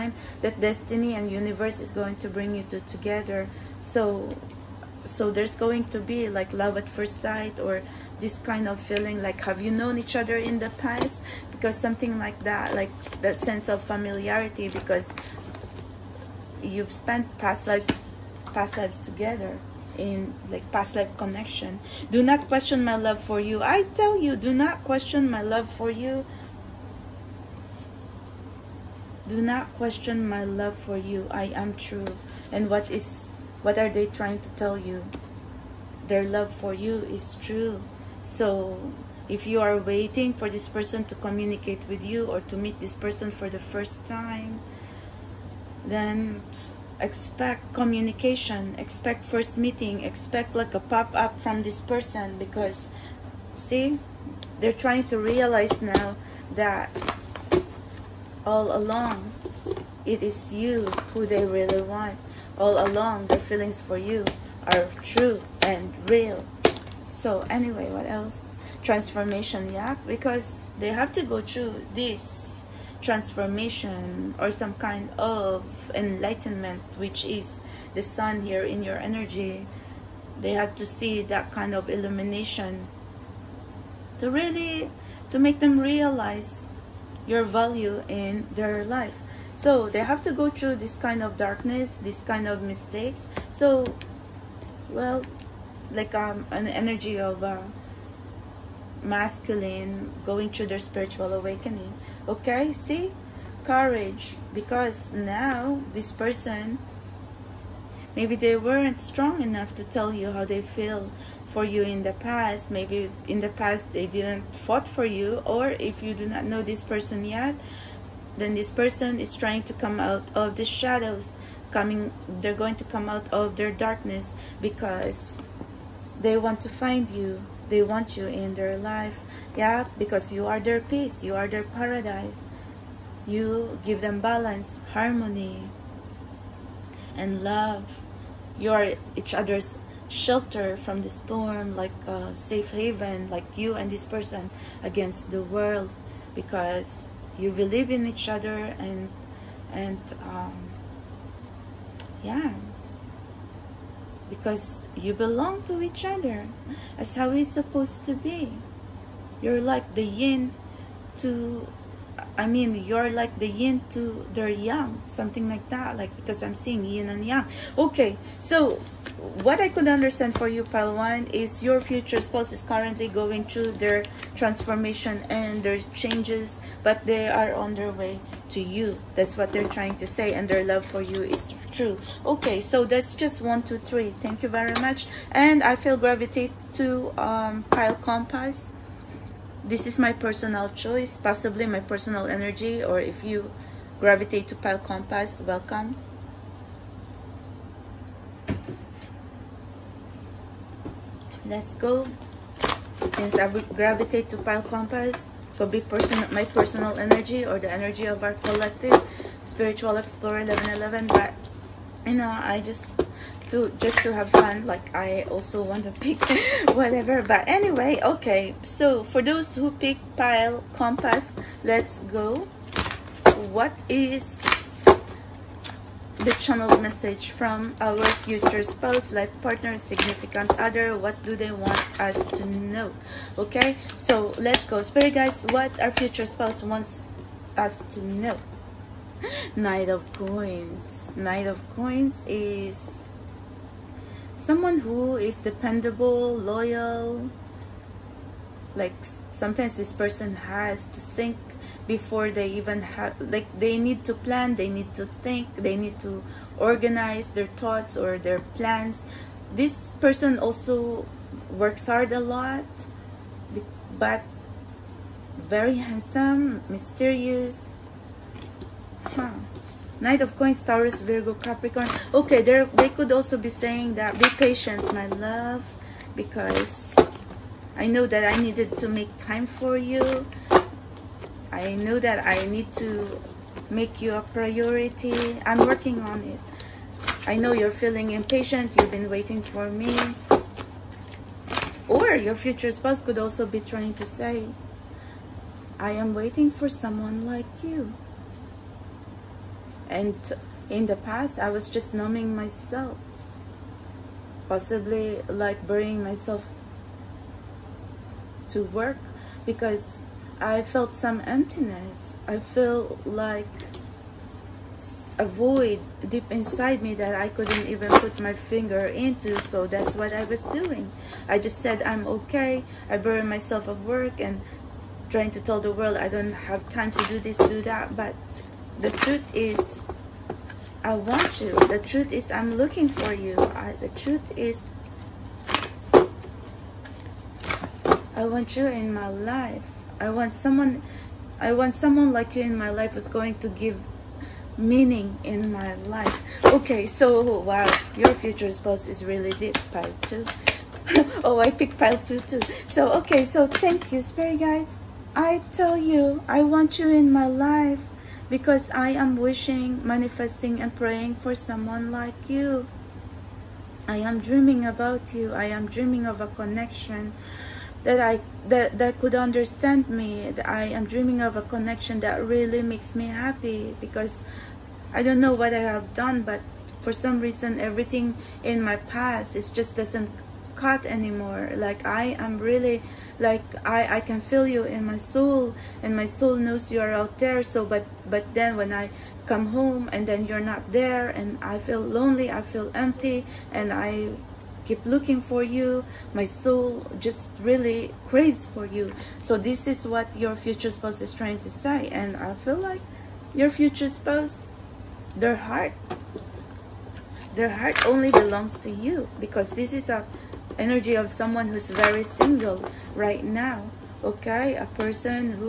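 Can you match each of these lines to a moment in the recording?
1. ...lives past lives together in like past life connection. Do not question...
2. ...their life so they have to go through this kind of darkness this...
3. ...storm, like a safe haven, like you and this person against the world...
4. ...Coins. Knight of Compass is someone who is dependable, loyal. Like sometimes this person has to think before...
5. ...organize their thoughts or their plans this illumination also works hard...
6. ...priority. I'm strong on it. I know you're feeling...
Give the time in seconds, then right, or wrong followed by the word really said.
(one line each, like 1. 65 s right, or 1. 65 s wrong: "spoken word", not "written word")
1. 17 s right
2. 88 s right
3. 141 s right
4. 240 s wrong: "Coins", not "Compass"
5. 256 s wrong: "person", not "illumination"
6. 284 s wrong: "working", not "strong".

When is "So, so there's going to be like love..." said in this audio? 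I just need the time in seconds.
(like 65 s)
3 s.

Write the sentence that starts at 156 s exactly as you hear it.
That's how it's supposed to be.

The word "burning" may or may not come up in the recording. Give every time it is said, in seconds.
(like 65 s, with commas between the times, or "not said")
not said.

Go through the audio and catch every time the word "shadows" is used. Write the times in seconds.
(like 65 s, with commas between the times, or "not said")
120 s.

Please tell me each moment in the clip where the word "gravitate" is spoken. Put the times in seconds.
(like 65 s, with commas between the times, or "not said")
185 s, 193 s, 203 s.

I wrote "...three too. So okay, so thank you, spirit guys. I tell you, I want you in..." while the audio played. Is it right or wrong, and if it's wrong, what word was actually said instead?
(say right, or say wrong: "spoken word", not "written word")
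wrong: "two", not "three".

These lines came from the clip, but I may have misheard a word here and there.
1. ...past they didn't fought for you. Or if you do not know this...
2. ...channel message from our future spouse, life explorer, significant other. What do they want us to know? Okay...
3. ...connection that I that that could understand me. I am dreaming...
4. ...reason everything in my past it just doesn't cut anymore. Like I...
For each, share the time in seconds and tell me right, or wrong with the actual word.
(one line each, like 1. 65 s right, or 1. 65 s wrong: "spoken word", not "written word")
1. 113 s right
2. 226 s wrong: "partner", not "explorer"
3. 366 s right
4. 377 s right.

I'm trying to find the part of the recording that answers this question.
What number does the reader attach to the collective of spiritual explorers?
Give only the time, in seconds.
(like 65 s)
210 s.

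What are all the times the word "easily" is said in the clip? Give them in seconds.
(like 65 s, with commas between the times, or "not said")
not said.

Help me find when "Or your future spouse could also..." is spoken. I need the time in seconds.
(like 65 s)
291 s.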